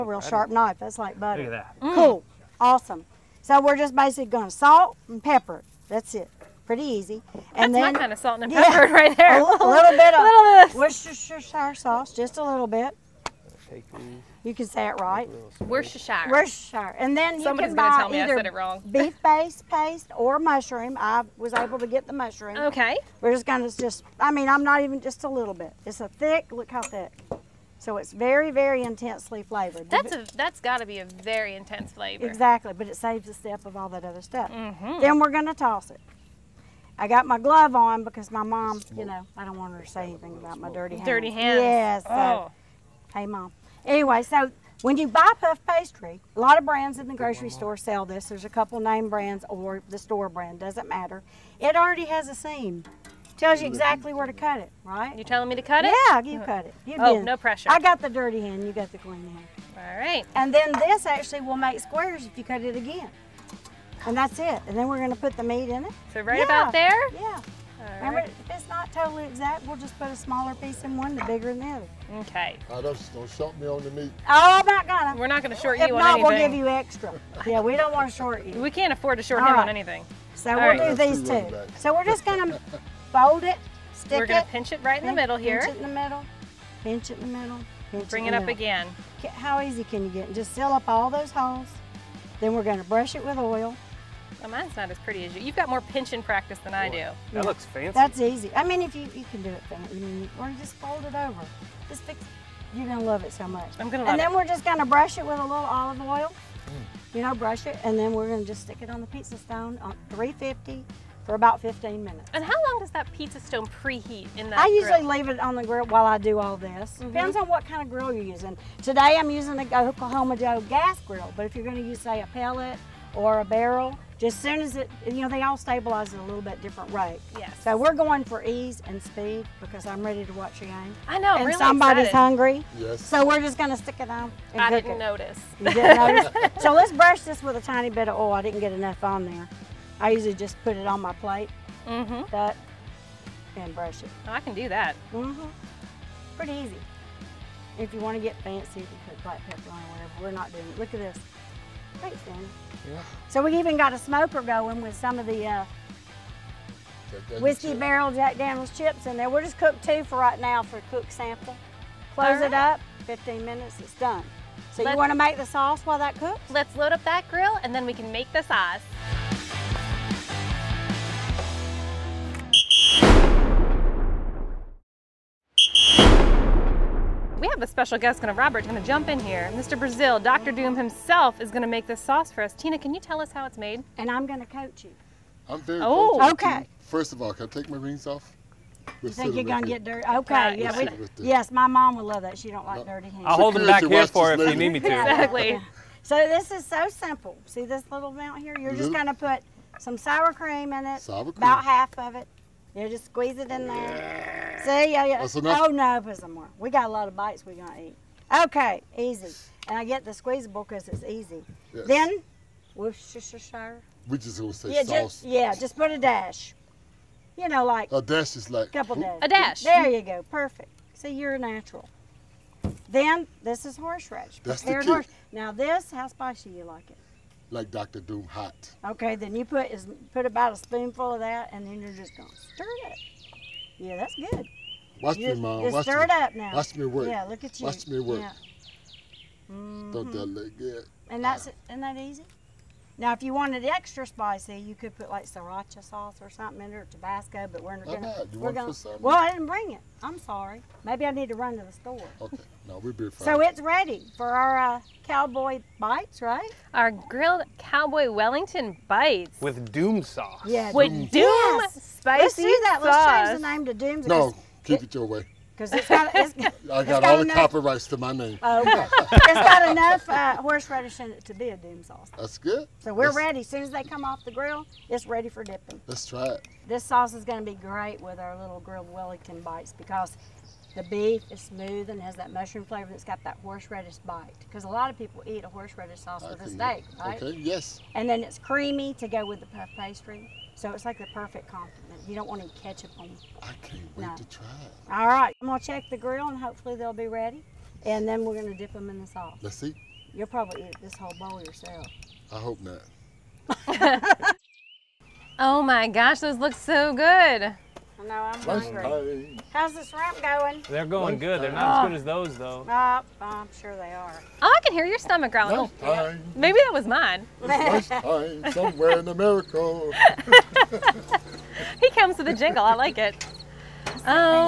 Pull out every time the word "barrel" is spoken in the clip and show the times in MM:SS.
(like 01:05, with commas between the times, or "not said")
02:03, 02:37.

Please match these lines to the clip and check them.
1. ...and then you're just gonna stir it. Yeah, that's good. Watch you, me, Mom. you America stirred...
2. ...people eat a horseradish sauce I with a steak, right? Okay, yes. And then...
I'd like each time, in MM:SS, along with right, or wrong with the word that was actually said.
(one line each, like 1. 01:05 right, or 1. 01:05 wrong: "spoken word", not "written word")
1. 03:51 wrong: "Watch", not "America"
2. 04:44 right.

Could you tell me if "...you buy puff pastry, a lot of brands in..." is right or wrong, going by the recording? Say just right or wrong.
right.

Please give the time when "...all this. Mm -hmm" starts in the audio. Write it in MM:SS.
01:56.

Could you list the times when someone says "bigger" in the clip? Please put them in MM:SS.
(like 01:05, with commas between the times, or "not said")
01:11.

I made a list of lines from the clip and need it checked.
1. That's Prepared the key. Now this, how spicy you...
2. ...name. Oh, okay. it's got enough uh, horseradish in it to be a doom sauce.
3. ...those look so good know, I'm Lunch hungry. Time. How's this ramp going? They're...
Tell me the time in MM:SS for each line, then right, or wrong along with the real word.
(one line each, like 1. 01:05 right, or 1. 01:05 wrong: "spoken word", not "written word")
1. 03:44 right
2. 04:28 right
3. 05:06 right.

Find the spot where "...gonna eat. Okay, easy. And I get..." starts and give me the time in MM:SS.
03:27.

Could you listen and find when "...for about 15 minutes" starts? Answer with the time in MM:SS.
01:51.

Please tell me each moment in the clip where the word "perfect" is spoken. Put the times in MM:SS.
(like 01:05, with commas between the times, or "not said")
03:40, 04:51.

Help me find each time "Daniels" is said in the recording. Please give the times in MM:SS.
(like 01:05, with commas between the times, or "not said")
02:38.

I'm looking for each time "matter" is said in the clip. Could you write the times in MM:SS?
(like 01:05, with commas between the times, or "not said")
00:50.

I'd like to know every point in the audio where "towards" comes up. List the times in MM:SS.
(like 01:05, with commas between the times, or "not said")
not said.